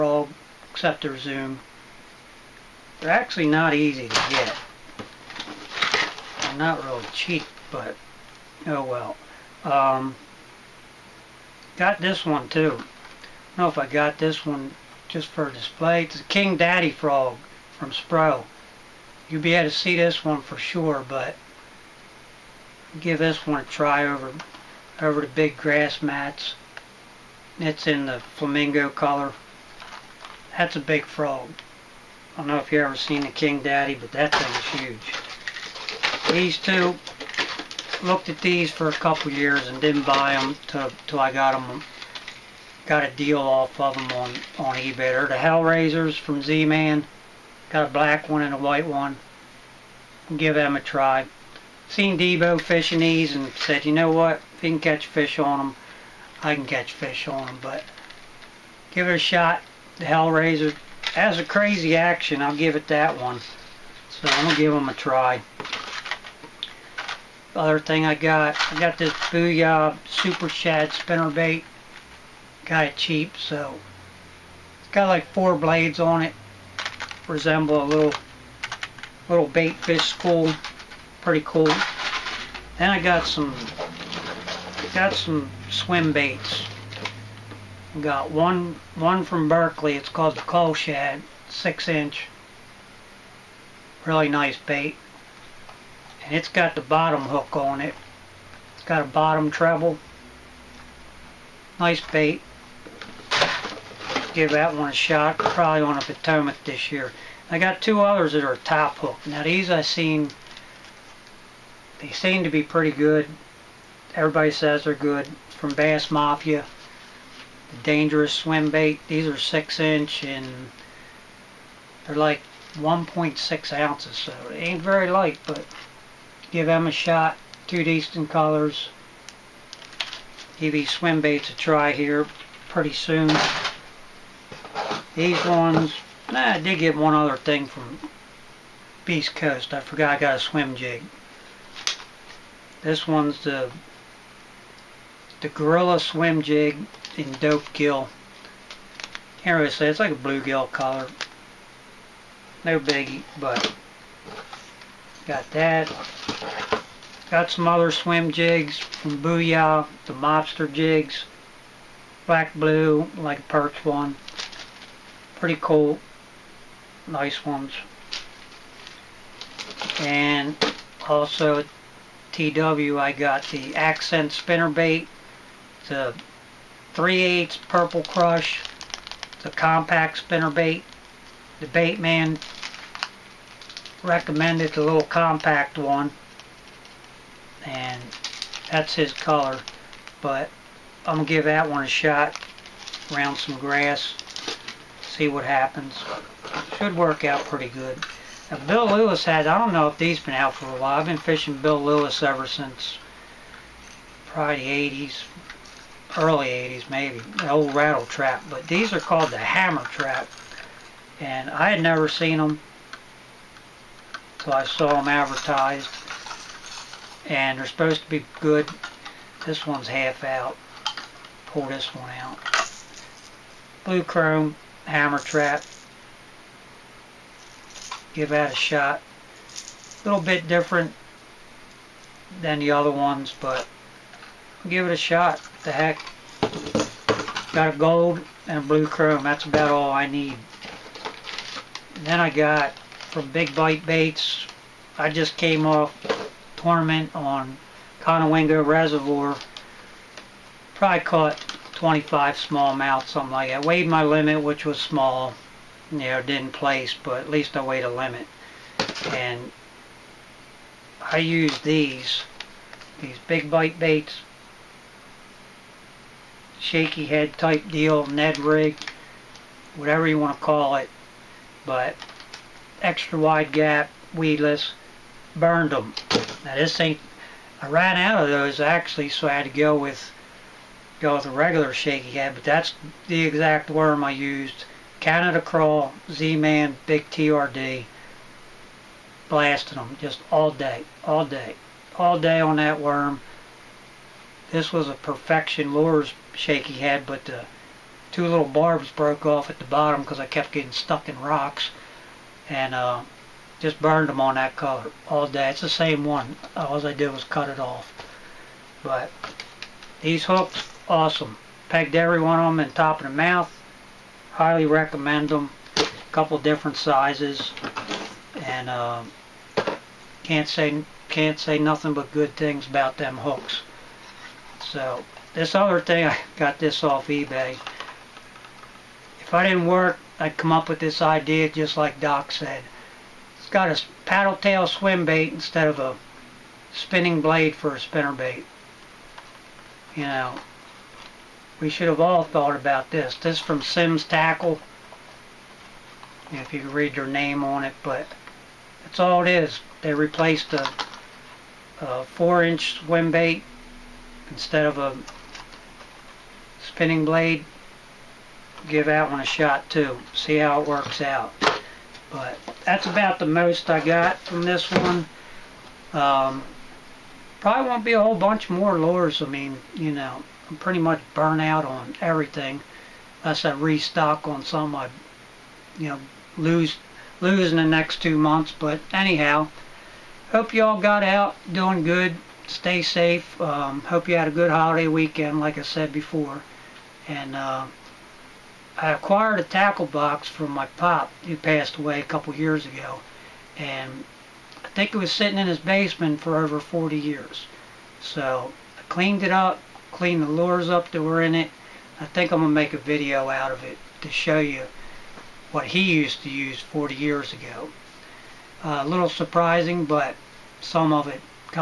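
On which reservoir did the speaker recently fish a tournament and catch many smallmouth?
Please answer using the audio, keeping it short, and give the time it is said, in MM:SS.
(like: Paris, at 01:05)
Conowingo Reservoir, at 04:08.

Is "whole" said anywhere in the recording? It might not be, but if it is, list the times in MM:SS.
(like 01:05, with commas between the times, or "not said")
06:08.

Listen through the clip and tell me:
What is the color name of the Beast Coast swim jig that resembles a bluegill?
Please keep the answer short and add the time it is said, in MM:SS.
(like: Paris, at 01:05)
Dope Gill, at 02:27.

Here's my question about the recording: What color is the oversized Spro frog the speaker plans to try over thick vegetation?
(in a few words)
Flamingo.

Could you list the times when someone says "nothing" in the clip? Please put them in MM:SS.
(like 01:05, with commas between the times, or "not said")
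05:21.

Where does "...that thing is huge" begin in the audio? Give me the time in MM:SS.
00:34.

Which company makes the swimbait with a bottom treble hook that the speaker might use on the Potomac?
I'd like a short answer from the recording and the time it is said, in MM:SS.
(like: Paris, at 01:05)
Berkley, at 01:29.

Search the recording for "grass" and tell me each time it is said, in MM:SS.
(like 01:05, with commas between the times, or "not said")
00:25, 03:13.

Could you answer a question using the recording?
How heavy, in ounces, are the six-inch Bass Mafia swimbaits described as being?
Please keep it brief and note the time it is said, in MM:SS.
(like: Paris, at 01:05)
1.6 ounces, at 02:02.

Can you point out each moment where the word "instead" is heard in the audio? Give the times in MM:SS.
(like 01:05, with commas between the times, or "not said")
05:35, 05:54.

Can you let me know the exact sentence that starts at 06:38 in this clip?
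So I cleaned it up, cleaned the lures up that were in it.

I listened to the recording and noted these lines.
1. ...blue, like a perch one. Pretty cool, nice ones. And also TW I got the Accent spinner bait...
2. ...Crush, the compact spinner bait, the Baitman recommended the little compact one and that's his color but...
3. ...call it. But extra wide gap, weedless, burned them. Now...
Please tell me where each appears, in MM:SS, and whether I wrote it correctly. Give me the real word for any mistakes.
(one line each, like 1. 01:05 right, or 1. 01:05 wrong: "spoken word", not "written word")
1. 02:42 right
2. 02:58 right
3. 04:30 right.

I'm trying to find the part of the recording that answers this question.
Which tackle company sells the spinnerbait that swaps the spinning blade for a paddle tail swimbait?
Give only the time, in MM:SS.
05:43.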